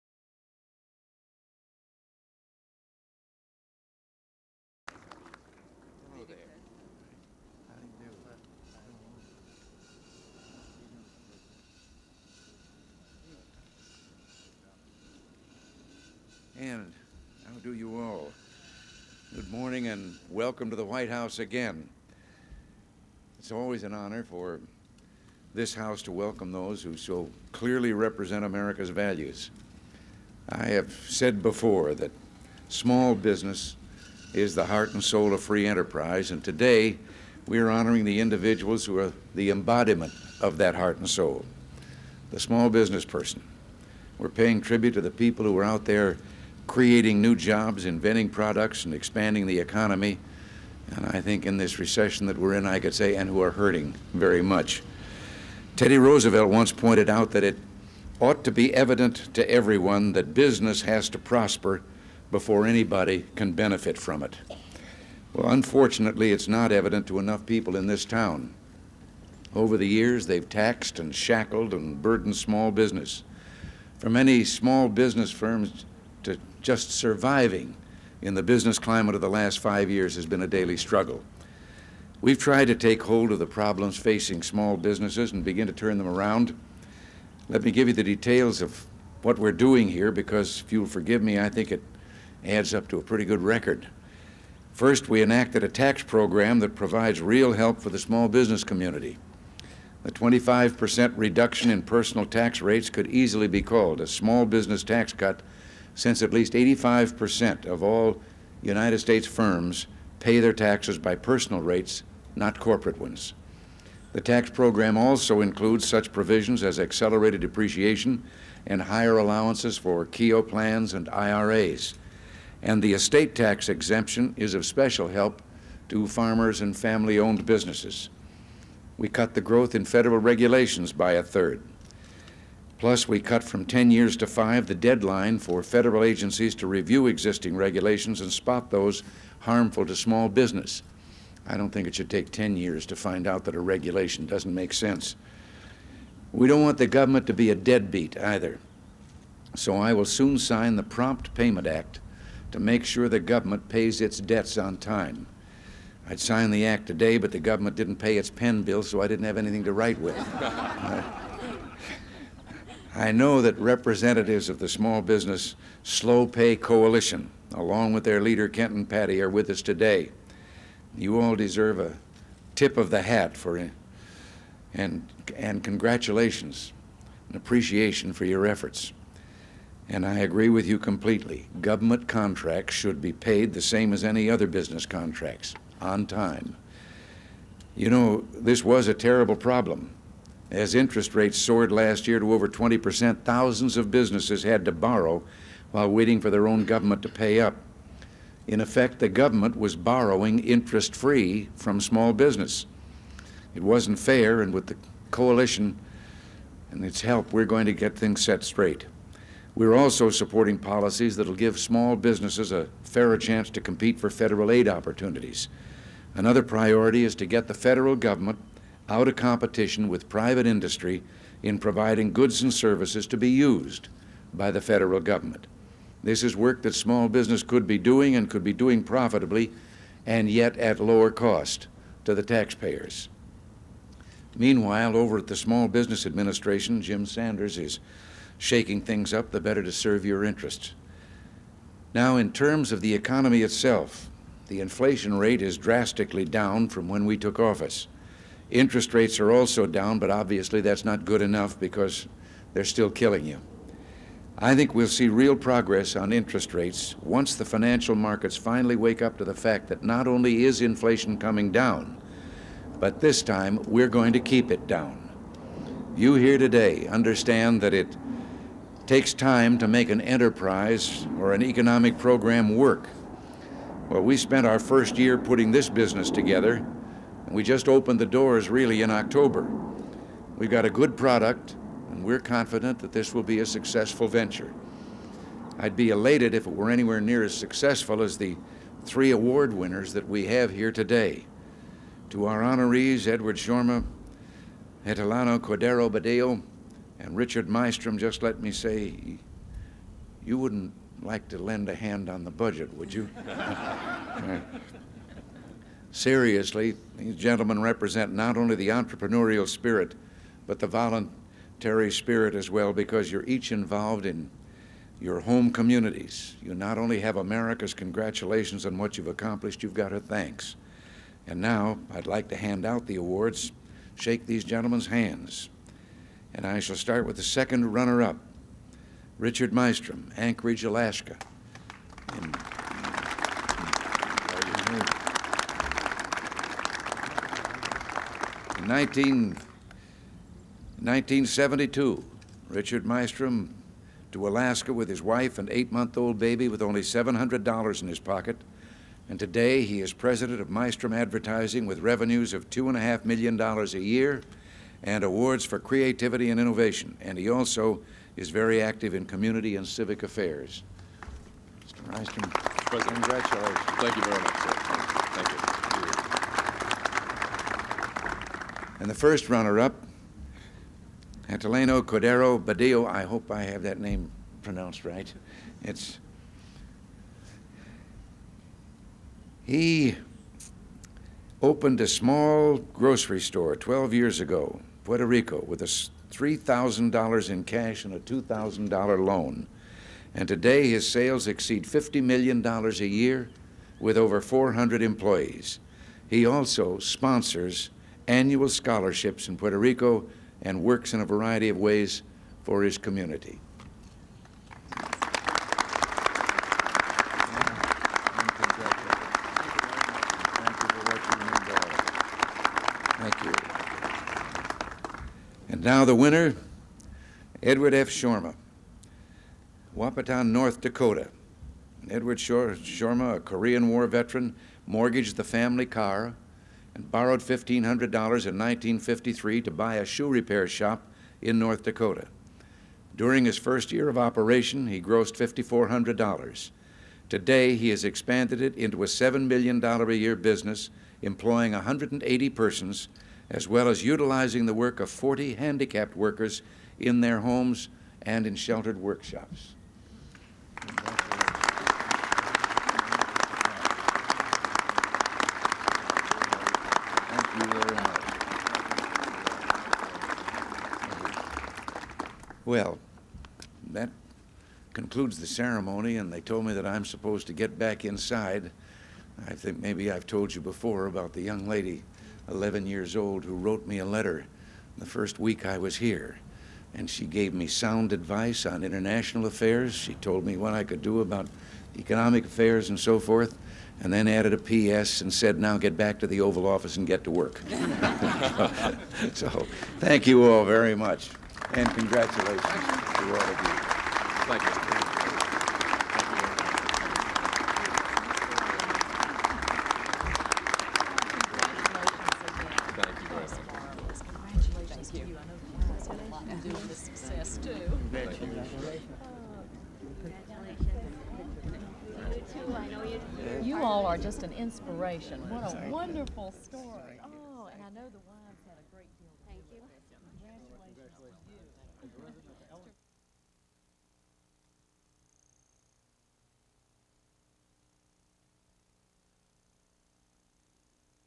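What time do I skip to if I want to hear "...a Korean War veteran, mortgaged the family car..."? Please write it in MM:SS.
07:03.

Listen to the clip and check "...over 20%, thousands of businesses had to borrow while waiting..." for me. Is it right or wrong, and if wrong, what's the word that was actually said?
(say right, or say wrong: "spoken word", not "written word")
right.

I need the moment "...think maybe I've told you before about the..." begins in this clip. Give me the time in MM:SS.
07:49.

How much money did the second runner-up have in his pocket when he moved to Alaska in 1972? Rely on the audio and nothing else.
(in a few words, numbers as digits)
$700.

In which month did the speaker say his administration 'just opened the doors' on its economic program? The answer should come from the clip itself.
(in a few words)
October.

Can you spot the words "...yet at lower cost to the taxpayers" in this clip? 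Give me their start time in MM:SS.
03:50.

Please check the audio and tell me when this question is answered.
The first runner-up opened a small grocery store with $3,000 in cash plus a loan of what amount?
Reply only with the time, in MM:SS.
06:27.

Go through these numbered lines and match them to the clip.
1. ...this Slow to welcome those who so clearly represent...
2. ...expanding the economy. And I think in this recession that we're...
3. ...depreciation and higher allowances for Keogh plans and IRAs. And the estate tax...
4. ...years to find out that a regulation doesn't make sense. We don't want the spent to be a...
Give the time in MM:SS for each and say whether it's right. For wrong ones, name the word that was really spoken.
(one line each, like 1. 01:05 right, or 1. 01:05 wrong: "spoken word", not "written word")
1. 00:25 wrong: "House", not "Slow"
2. 00:48 right
3. 01:57 right
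4. 02:22 wrong: "government", not "spent".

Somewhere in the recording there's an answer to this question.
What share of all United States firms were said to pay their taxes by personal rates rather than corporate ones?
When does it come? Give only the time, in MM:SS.
01:46.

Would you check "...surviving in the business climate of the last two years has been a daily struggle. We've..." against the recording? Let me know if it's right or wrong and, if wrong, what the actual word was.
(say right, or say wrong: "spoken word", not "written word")
wrong: "five", not "two".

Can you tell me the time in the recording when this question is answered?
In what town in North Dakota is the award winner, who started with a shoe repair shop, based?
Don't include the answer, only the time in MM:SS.
06:59.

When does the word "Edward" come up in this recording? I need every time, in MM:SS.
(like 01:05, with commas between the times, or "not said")
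04:53, 06:57, 07:01.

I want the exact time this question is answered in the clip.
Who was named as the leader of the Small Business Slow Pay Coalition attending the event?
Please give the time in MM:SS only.
02:48.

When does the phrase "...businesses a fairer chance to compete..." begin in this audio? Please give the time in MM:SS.
03:31.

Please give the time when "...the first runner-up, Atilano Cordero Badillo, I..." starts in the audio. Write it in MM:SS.
06:08.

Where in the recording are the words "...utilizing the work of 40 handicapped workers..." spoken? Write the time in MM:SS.
07:23.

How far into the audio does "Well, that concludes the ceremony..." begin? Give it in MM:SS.
07:42.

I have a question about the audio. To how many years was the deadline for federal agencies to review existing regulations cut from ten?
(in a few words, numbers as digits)
5.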